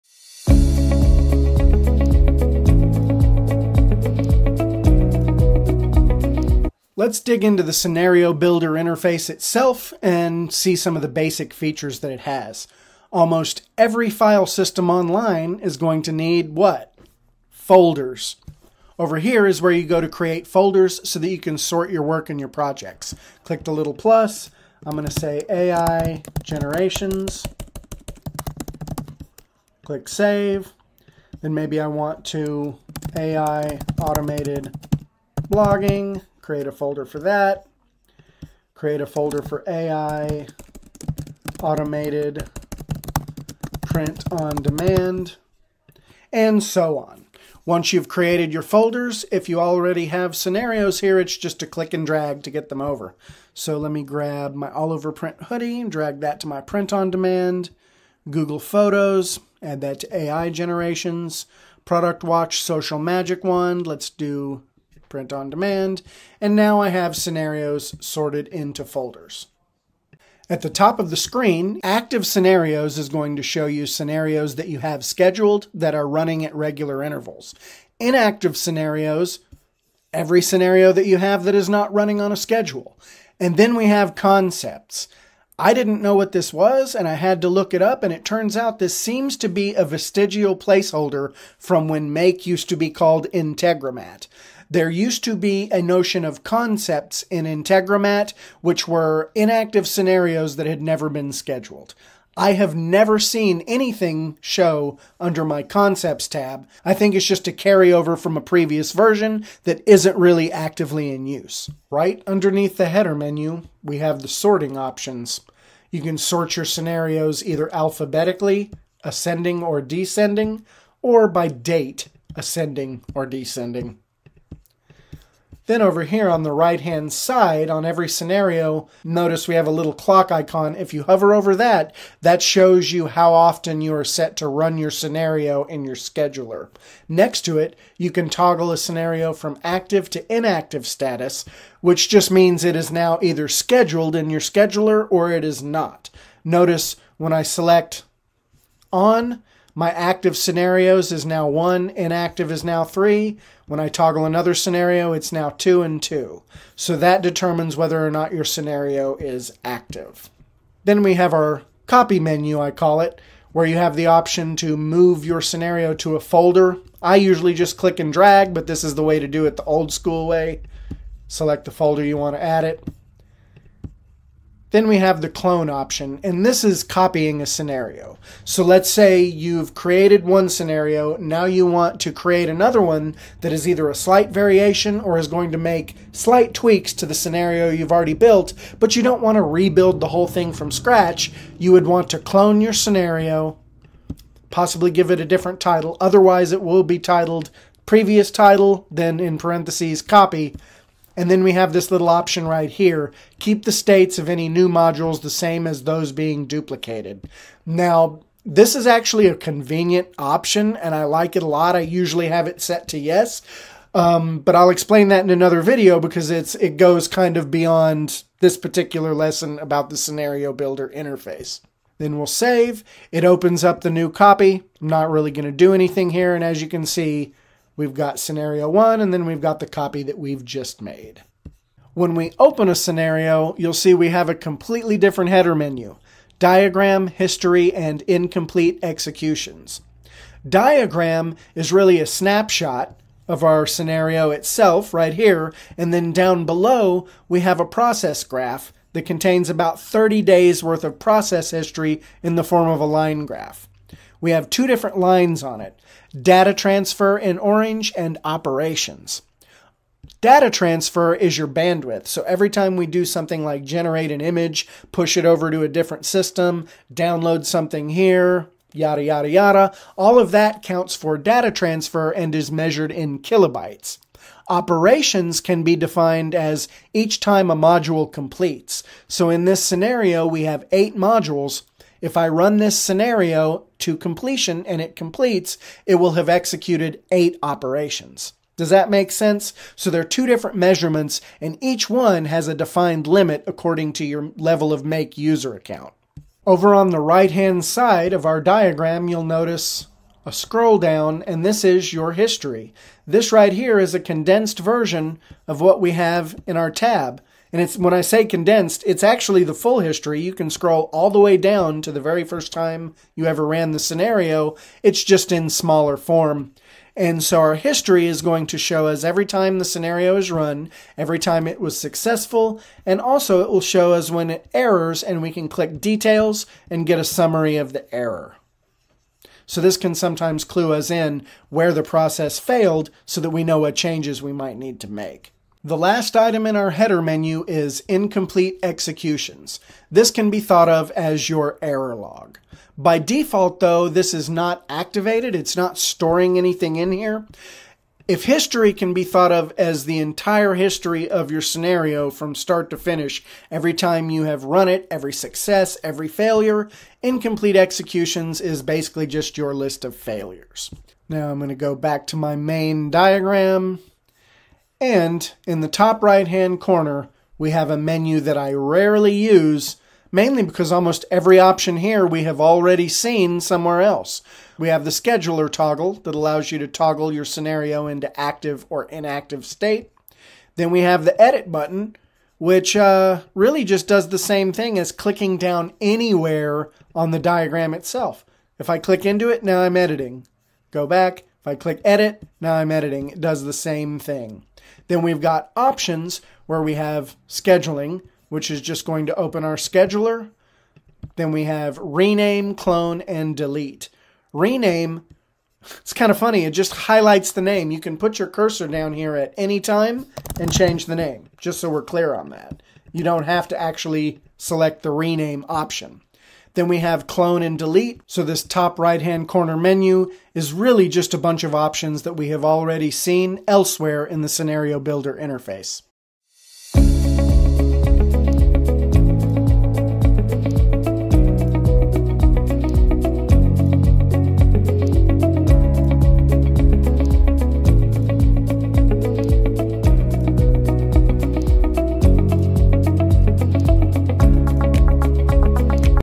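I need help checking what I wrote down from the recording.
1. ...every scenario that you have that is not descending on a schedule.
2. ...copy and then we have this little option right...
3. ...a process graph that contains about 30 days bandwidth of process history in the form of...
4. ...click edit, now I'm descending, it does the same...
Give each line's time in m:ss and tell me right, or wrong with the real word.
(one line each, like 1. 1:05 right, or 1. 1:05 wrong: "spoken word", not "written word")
1. 1:20 wrong: "running", not "descending"
2. 3:20 right
3. 4:07 wrong: "worth", not "bandwidth"
4. 6:31 wrong: "editing", not "descending".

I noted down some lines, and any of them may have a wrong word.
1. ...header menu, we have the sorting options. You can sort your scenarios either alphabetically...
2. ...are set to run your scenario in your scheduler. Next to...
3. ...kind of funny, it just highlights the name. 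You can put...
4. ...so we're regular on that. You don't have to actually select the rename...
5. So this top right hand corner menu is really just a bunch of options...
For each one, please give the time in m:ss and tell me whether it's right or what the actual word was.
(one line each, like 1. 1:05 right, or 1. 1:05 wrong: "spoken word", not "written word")
1. 1:52 right
2. 2:13 right
3. 6:45 right
4. 6:51 wrong: "clear", not "regular"
5. 6:58 right.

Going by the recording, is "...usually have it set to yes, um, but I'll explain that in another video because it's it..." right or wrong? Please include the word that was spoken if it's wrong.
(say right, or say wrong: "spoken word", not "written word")
right.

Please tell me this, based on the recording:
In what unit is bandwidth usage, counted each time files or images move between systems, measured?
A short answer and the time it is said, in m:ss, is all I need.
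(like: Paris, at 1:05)
kilobytes, at 4:33.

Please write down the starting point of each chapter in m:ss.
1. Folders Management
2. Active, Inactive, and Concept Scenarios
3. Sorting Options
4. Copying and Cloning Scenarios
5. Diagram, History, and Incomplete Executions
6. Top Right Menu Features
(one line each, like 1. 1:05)
1. 0:11
2. 1:12
3. 1:52
4. 2:06
5. 4:00
6. 6:06.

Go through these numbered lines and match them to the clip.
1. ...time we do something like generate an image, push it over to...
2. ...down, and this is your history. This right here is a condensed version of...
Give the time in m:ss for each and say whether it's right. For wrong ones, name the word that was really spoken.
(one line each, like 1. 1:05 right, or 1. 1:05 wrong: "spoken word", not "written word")
1. 4:22 right
2. 5:00 right.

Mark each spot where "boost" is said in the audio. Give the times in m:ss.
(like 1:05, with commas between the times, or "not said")
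not said.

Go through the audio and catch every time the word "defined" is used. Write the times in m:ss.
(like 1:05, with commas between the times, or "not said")
4:35, 4:52.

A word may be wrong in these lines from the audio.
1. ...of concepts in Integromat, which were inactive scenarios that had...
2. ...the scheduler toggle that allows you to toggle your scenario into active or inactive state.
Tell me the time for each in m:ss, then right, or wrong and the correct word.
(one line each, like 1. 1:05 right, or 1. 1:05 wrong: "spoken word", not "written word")
1. 1:36 right
2. 6:14 right.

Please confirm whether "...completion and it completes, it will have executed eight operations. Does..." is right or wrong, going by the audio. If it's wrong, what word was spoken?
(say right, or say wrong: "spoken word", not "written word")
right.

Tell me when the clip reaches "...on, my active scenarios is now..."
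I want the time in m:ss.
2:28.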